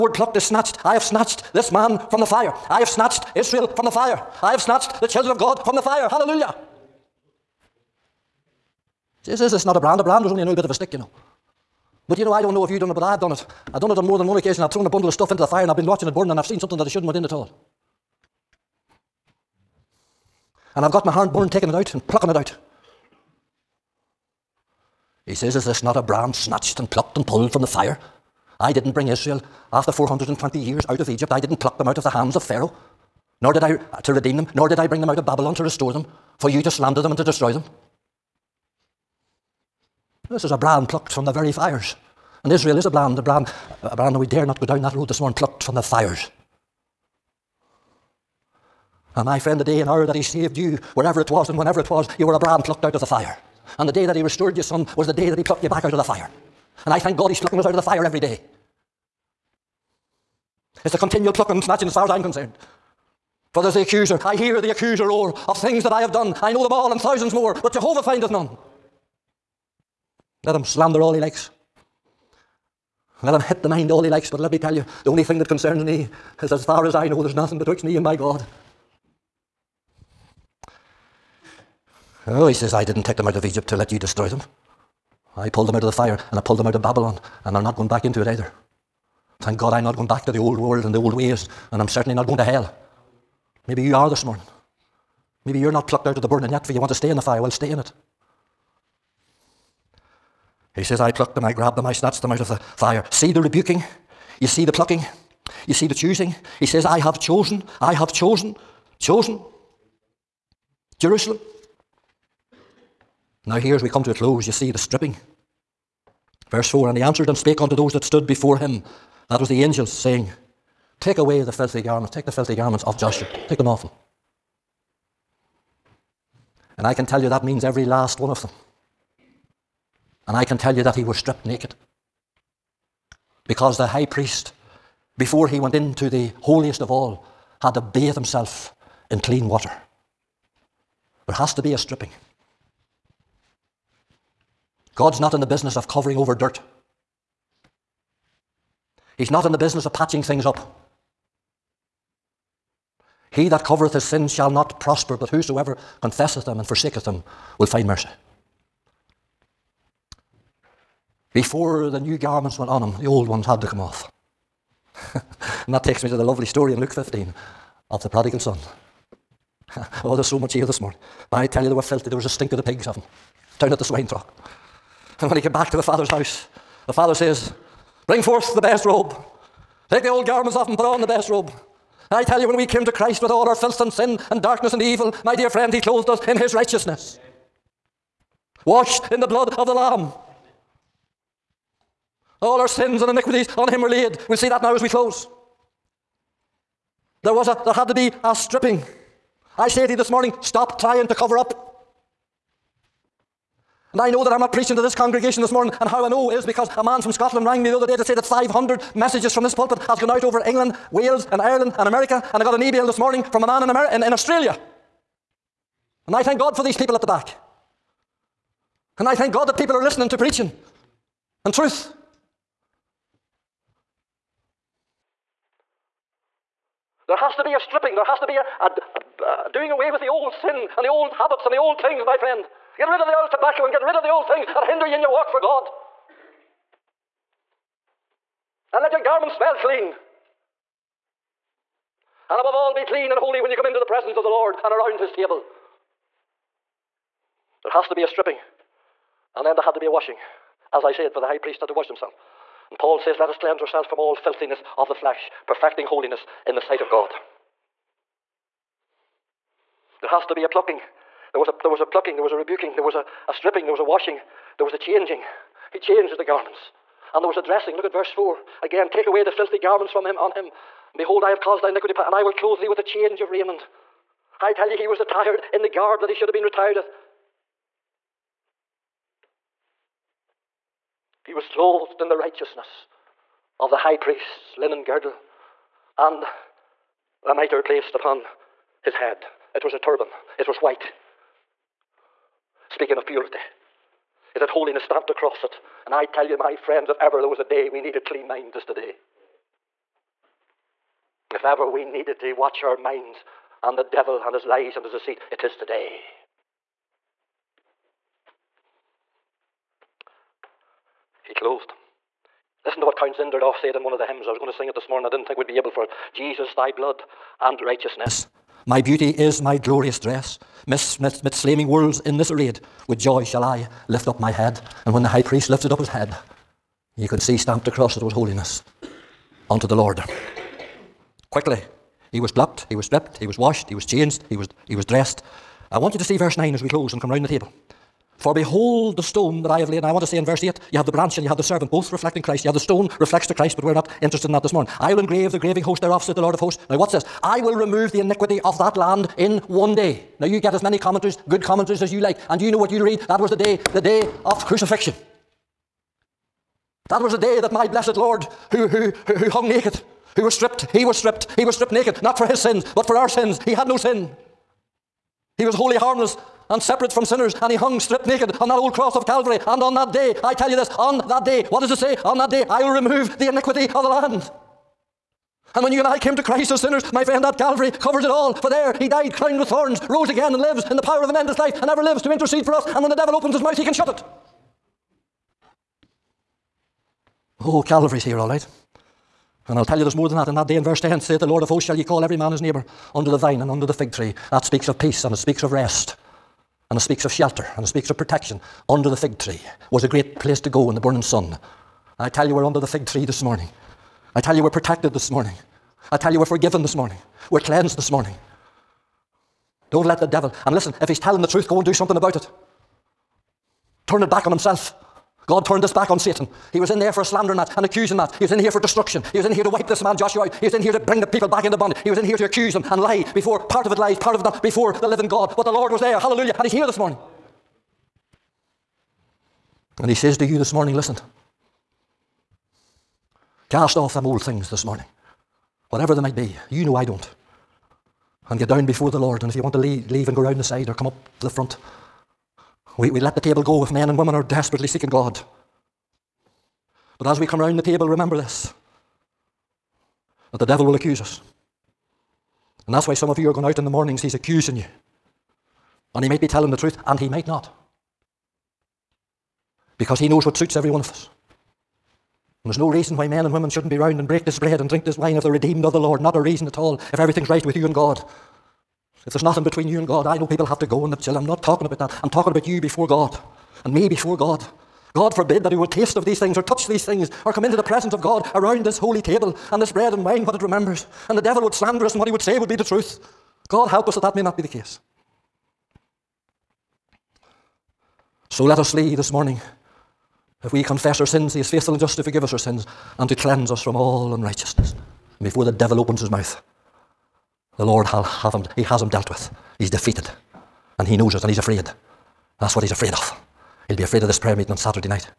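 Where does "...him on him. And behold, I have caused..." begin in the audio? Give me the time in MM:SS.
04:30.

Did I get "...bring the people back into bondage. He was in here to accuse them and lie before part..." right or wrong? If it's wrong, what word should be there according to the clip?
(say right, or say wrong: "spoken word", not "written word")
right.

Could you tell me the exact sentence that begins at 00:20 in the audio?
And I've got my hand born taking it out and plucking it out.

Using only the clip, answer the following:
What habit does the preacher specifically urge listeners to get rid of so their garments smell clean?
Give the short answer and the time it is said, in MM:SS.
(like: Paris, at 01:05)
tobacco, at 03:53.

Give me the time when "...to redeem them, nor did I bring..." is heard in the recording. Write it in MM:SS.
00:34.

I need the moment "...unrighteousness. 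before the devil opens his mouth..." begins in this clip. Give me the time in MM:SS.
08:14.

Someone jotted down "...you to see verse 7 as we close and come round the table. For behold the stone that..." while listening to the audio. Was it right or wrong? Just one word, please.
wrong.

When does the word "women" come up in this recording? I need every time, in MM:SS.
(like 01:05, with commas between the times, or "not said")
07:23, 07:43.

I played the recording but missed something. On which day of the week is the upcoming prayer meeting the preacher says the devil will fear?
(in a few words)
Saturday.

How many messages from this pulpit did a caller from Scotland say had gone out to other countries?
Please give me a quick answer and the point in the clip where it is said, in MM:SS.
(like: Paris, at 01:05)
500, at 03:28.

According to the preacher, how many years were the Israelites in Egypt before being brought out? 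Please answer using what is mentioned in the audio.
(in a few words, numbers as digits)
420.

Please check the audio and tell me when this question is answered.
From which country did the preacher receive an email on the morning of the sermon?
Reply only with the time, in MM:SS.
03:34.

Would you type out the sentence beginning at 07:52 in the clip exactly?
I'm talking about you before God and me before God.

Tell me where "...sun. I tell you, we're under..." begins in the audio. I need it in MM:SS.
06:41.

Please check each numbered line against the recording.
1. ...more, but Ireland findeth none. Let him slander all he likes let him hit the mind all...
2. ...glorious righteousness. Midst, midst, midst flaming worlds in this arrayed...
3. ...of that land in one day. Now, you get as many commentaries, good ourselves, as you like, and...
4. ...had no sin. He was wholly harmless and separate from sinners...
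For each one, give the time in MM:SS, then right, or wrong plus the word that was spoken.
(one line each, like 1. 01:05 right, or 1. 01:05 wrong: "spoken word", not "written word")
1. 01:07 wrong: "Jehovah", not "Ireland"
2. 05:19 wrong: "dress", not "righteousness"
3. 05:48 wrong: "commentaries", not "ourselves"
4. 06:03 right.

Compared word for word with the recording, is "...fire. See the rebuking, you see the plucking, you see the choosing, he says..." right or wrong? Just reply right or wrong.
right.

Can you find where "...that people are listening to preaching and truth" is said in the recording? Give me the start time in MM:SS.
03:39.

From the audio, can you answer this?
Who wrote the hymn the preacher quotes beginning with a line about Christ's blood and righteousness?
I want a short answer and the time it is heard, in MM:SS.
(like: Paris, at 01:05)
Count Zinzendorf, at 05:12.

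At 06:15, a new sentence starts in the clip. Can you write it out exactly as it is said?
And when you and I came to Christ as sinners, my friend, that Calvary covers it all.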